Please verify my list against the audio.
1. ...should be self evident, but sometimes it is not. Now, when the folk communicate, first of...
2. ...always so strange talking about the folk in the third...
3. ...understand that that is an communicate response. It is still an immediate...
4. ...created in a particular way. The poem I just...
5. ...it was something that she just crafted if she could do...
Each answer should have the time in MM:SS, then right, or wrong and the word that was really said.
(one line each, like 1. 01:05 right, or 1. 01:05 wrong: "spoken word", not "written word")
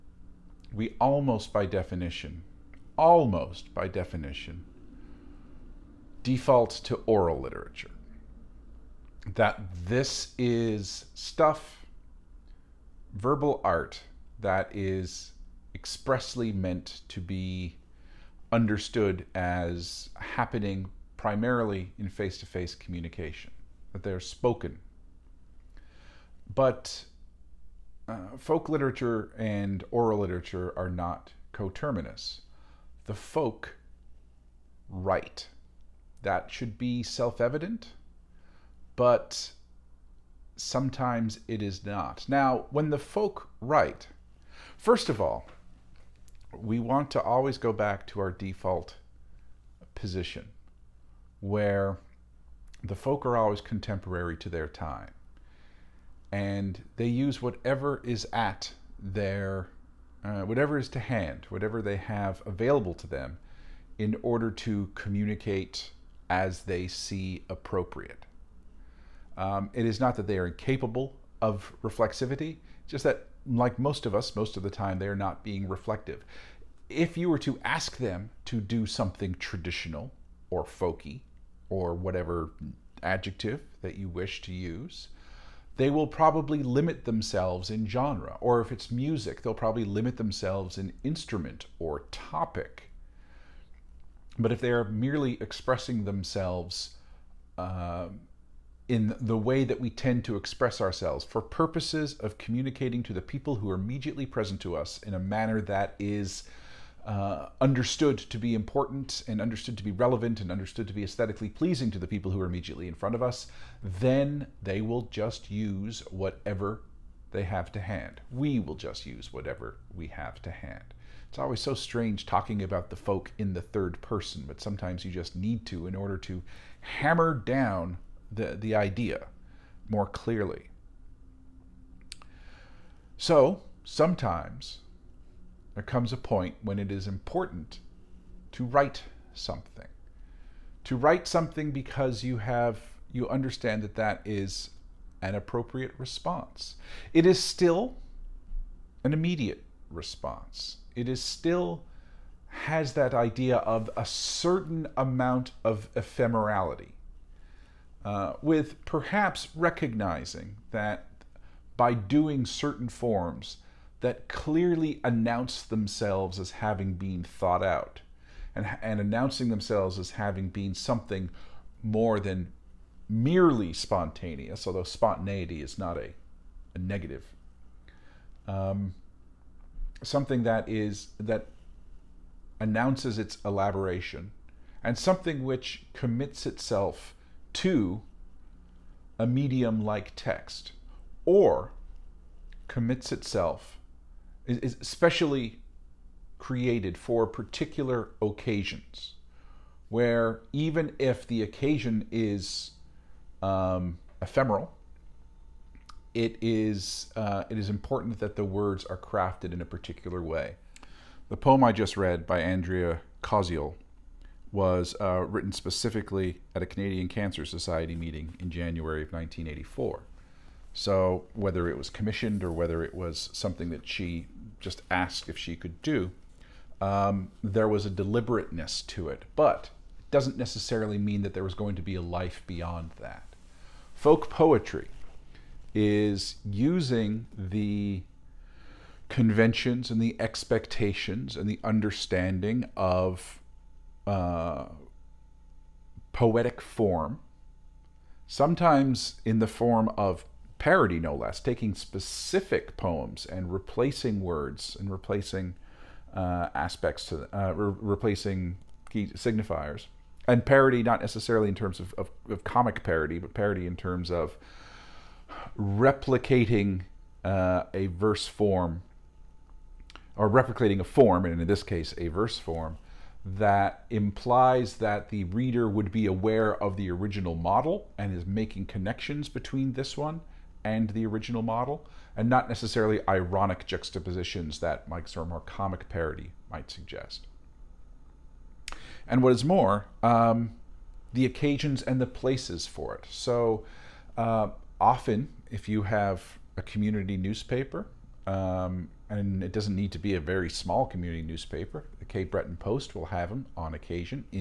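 1. 00:36 wrong: "write", not "communicate"
2. 02:01 right
3. 02:23 wrong: "appropriate", not "communicate"
4. 03:28 wrong: "crafted", not "created"
5. 03:42 wrong: "asked", not "crafted".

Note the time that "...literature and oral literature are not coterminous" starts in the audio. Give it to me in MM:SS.
00:28.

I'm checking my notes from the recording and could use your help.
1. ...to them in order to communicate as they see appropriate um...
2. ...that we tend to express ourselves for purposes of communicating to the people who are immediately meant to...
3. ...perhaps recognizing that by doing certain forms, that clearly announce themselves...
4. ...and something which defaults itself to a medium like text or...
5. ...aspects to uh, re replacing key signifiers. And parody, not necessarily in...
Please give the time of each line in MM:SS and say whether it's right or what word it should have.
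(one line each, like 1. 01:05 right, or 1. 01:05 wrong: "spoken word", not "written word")
1. 01:02 right
2. 01:39 wrong: "present", not "meant"
3. 02:38 right
4. 03:04 wrong: "commits", not "defaults"
5. 04:16 right.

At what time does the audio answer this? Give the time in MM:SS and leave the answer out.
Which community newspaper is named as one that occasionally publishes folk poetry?
05:01.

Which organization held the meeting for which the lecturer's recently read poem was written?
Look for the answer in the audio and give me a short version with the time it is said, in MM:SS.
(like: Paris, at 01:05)
Canadian Cancer Society, at 03:36.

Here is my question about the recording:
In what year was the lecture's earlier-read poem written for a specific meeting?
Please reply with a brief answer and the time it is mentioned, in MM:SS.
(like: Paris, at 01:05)
1984, at 03:39.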